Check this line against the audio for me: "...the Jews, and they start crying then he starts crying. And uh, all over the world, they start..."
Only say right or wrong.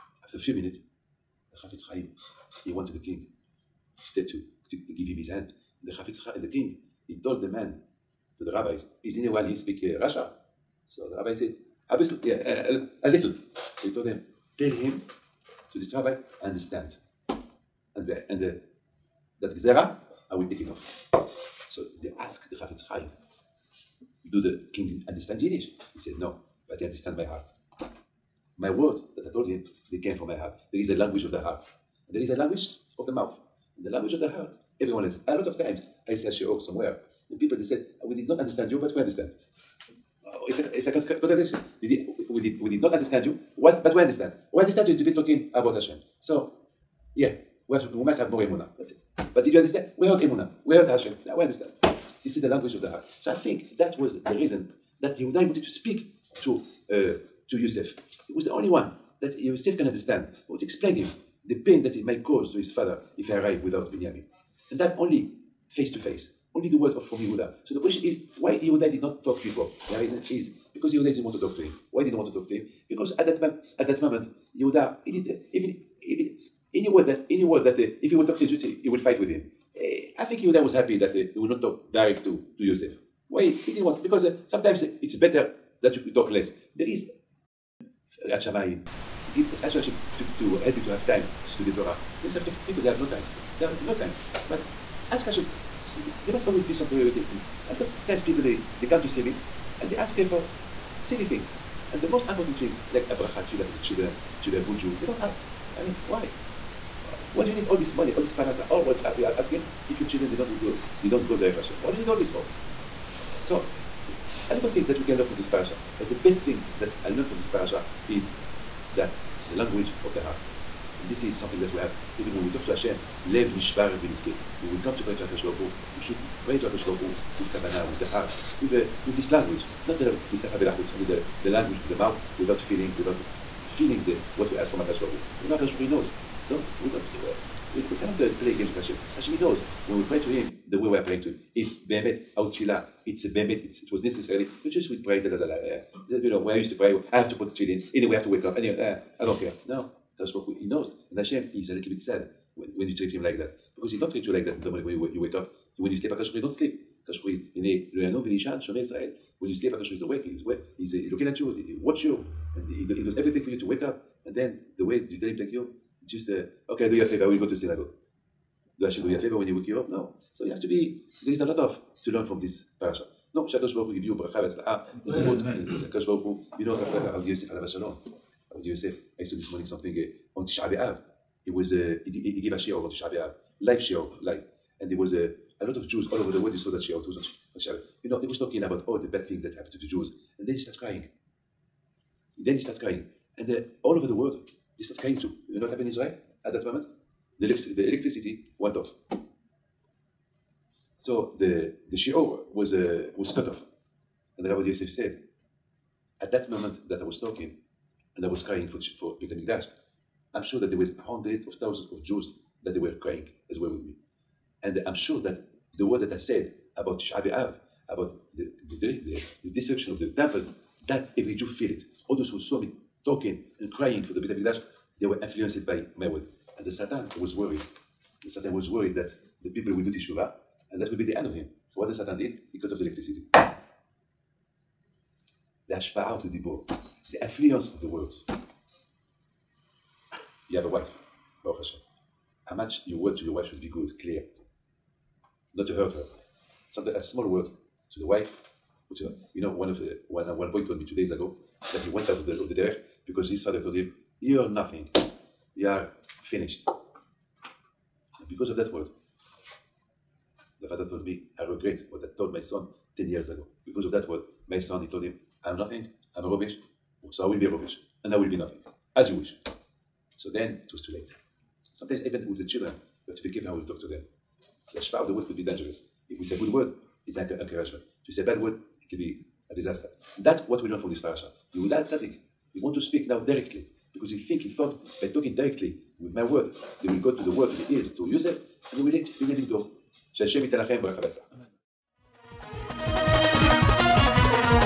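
right.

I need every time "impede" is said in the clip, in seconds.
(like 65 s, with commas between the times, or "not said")
not said.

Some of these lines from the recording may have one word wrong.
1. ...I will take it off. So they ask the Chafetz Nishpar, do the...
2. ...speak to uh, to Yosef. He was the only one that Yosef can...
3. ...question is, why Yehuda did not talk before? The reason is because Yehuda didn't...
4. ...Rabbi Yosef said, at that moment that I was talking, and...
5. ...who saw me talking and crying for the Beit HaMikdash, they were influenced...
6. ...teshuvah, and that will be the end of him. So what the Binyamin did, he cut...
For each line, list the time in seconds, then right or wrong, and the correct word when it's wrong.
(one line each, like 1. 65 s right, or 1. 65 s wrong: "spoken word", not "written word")
1. 20 s wrong: "Chaim", not "Nishpar"
2. 55 s right
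3. 67 s right
4. 204 s right
5. 222 s right
6. 229 s wrong: "Satan", not "Binyamin".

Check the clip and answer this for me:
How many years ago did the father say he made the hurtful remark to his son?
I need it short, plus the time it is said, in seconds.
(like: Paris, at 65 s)
10, at 262 s.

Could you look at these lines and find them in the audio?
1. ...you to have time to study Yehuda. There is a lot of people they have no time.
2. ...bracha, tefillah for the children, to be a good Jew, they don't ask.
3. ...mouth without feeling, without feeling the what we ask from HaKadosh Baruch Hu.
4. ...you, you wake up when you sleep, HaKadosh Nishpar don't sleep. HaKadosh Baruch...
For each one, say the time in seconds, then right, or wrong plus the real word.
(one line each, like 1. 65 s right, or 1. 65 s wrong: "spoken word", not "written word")
1. 90 s wrong: "Torah", not "Yehuda"
2. 103 s right
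3. 131 s right
4. 154 s wrong: "Baruch", not "Nishpar".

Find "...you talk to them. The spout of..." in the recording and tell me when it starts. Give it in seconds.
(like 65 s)
273 s.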